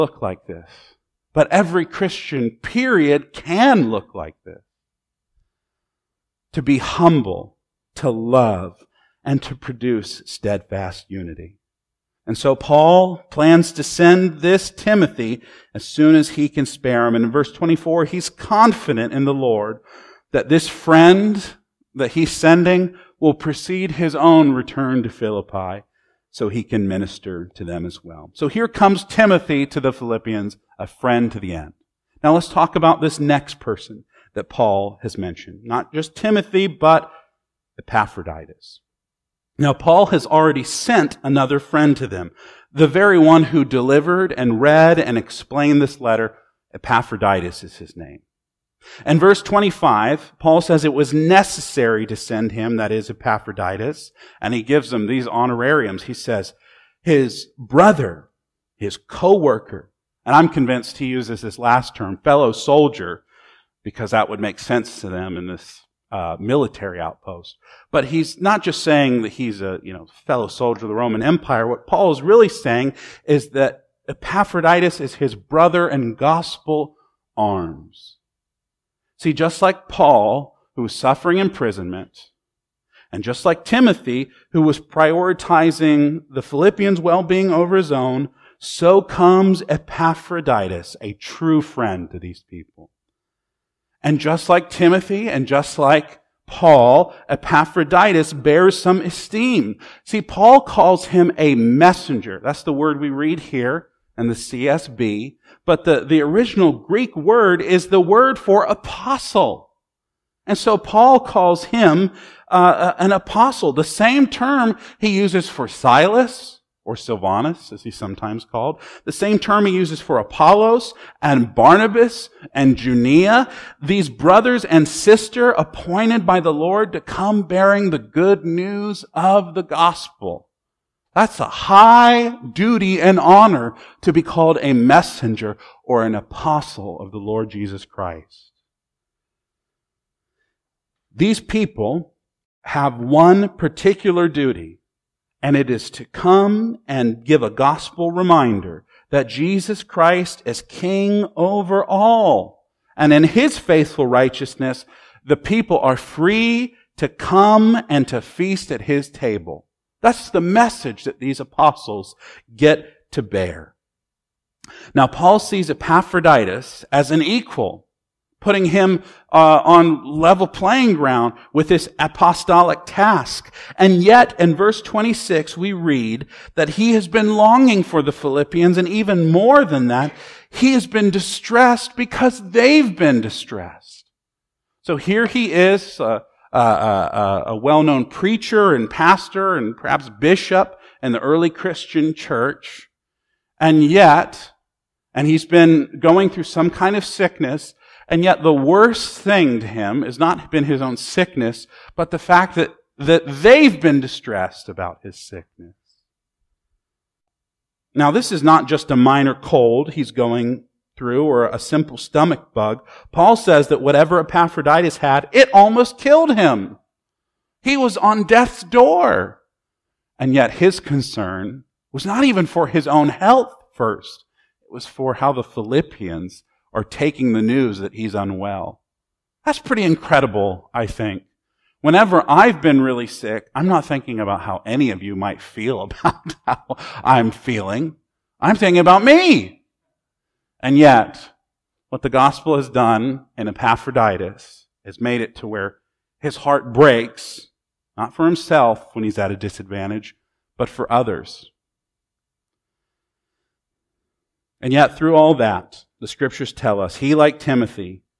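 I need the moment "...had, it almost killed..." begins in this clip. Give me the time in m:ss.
3:34.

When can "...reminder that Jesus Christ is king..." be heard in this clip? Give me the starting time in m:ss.
2:28.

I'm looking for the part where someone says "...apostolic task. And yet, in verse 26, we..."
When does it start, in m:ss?
2:51.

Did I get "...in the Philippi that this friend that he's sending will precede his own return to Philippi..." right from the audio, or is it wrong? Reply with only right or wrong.
wrong.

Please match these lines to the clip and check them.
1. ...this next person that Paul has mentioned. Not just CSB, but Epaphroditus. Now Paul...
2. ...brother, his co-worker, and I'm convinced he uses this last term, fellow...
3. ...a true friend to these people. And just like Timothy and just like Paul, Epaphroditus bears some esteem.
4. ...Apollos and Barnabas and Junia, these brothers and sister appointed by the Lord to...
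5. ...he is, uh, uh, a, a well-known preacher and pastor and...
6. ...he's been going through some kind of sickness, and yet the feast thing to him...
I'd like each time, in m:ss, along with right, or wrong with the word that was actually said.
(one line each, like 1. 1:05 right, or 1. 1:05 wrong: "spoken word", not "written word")
1. 0:33 wrong: "Timothy", not "CSB"
2. 0:57 right
3. 1:31 right
4. 2:00 right
5. 3:05 right
6. 3:15 wrong: "worst", not "feast".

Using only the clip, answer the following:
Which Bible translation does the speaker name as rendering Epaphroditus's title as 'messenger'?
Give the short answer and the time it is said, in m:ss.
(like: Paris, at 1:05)
CSB, at 1:44.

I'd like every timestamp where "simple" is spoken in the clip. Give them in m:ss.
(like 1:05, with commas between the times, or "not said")
3:31.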